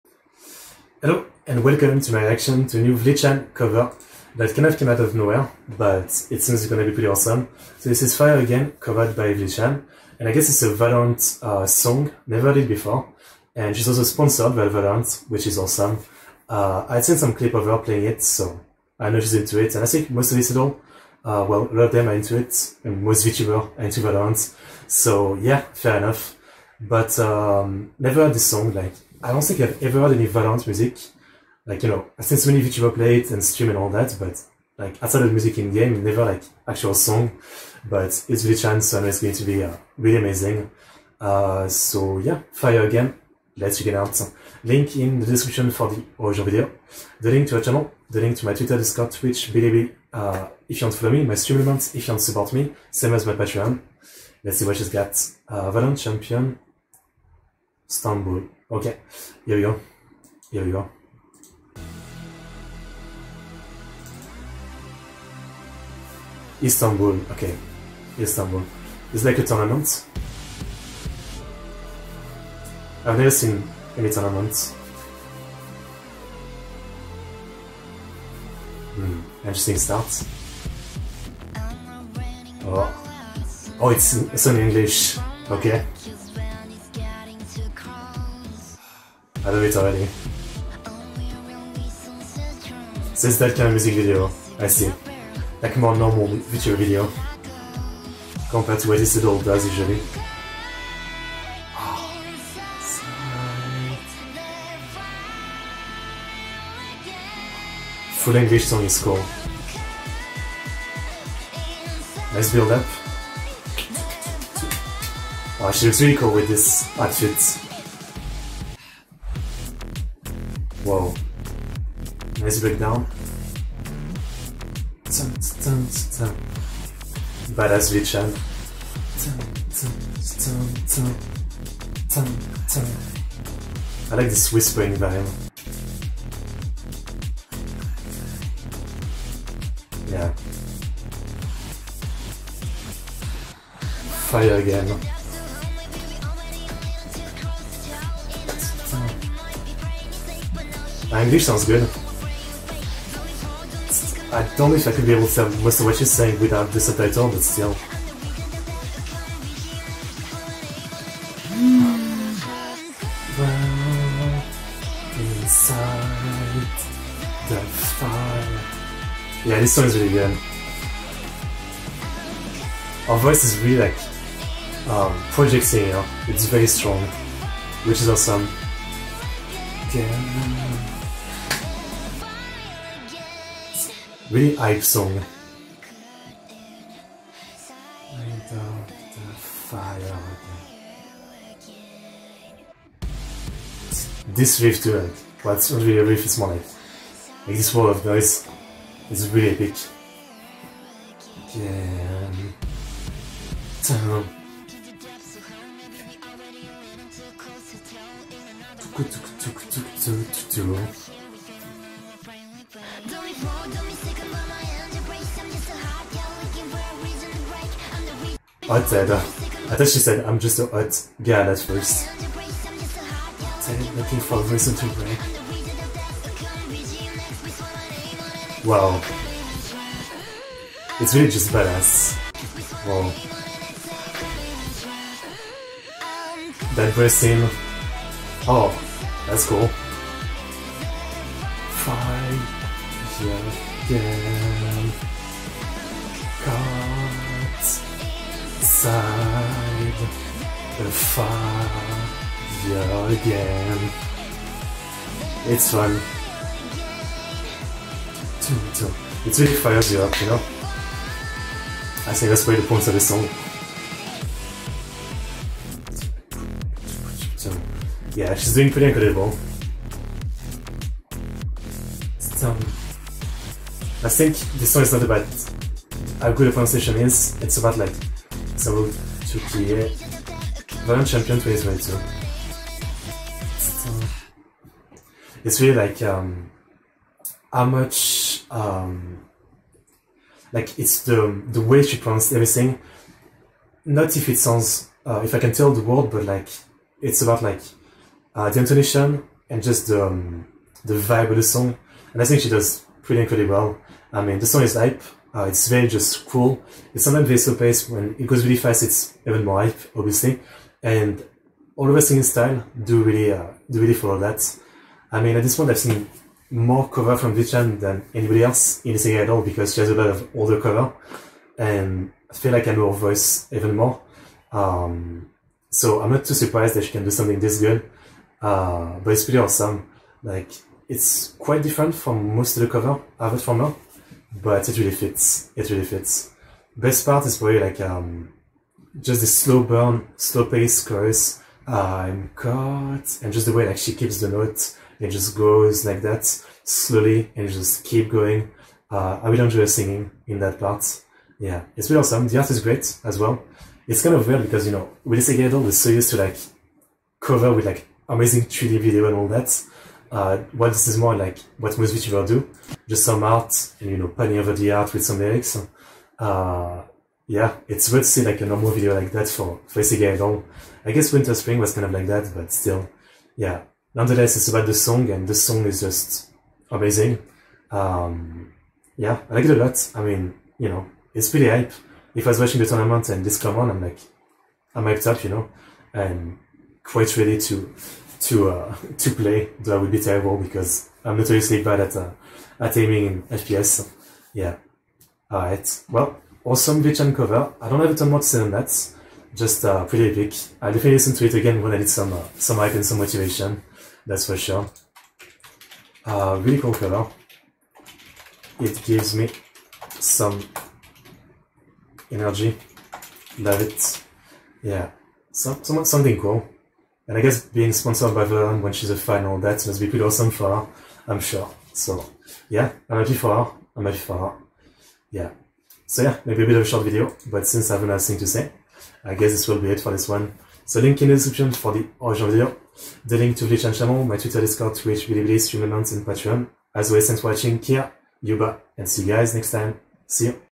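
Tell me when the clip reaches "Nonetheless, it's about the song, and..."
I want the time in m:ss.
6:13.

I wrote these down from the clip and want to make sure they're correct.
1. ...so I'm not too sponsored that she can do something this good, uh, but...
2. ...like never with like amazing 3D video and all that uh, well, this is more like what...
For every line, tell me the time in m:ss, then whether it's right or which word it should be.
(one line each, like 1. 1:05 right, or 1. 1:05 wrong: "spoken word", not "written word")
1. 5:25 wrong: "surprised", not "sponsored"
2. 5:56 wrong: "cover", not "never".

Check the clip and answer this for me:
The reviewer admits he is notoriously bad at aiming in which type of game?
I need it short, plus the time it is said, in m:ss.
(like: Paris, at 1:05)
FPS, at 6:33.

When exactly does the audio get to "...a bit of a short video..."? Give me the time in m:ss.
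7:06.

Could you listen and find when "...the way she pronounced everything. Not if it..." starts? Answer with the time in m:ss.
4:51.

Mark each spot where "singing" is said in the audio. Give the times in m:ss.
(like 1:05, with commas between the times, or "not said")
5:12, 5:18, 5:49.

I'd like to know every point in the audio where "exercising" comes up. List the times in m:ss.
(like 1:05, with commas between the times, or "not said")
not said.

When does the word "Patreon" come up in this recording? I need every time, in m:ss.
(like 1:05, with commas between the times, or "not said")
0:53, 7:16.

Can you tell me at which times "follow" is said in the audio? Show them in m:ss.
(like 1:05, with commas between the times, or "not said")
0:51, 5:13.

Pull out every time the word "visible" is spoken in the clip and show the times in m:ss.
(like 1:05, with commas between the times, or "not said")
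not said.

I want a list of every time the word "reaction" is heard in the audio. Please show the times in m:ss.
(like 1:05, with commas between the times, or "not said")
0:02.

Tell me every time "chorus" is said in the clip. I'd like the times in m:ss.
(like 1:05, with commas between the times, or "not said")
5:40.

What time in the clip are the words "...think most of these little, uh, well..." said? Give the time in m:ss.
0:19.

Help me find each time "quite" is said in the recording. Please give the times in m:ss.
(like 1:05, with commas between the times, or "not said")
5:31, 6:26.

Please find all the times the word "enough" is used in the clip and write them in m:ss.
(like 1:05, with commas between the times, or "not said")
0:25.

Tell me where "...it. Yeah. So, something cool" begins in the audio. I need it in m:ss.
6:53.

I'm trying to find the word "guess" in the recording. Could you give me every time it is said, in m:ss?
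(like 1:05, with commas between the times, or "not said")
0:10, 6:10, 6:57, 7:09.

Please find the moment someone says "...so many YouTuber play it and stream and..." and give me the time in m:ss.
0:32.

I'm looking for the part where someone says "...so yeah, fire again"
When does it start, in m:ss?
0:41.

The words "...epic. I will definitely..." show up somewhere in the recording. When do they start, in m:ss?
6:40.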